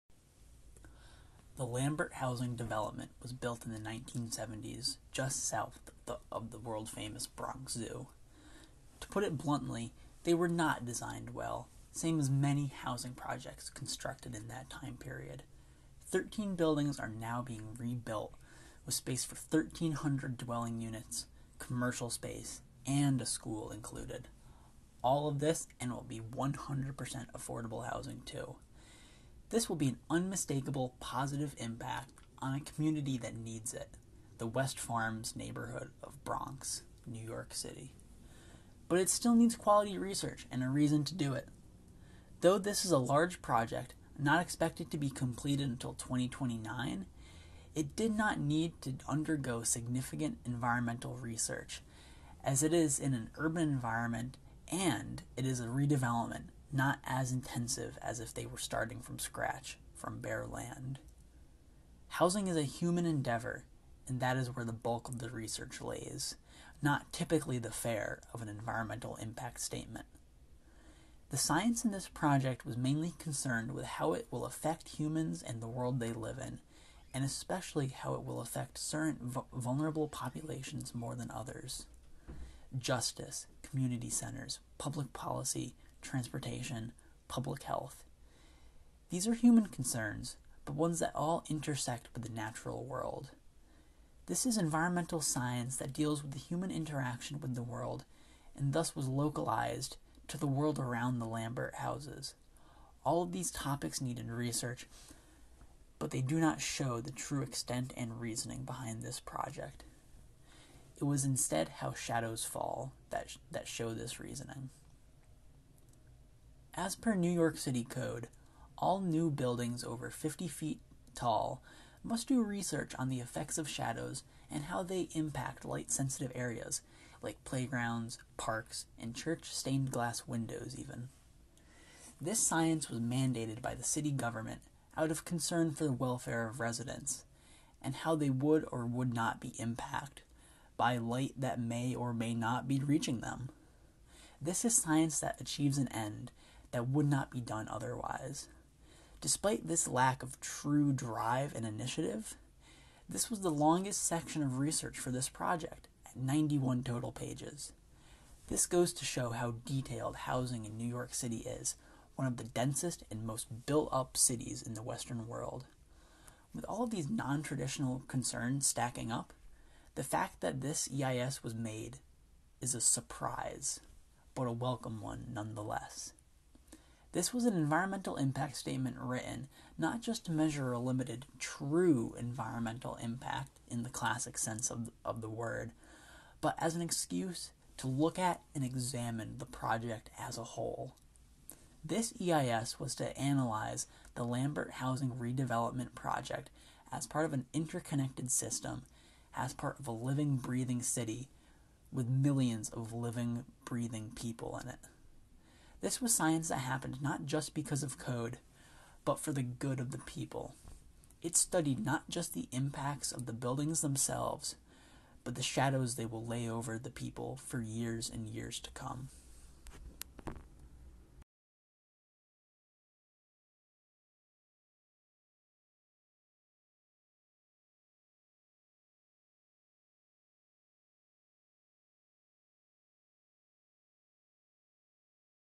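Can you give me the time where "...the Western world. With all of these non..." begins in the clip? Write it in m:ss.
2:44.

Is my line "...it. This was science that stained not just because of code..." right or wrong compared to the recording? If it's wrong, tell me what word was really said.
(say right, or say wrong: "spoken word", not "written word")
wrong: "happened", not "stained".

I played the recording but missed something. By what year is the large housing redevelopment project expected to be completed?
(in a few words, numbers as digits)
2029.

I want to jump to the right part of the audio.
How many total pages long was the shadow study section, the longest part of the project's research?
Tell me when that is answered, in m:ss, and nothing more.
2:36.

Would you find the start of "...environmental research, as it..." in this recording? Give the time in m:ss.
0:50.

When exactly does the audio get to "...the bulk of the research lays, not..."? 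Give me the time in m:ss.
1:04.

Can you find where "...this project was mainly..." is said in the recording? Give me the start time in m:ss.
1:11.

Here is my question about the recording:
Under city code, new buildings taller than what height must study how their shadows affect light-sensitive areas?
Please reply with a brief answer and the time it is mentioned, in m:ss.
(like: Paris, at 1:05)
50 feet, at 2:00.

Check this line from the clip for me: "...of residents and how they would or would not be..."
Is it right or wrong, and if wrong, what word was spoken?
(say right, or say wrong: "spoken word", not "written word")
right.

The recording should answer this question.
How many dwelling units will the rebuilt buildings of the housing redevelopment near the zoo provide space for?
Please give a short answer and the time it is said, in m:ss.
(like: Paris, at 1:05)
1,300, at 0:19.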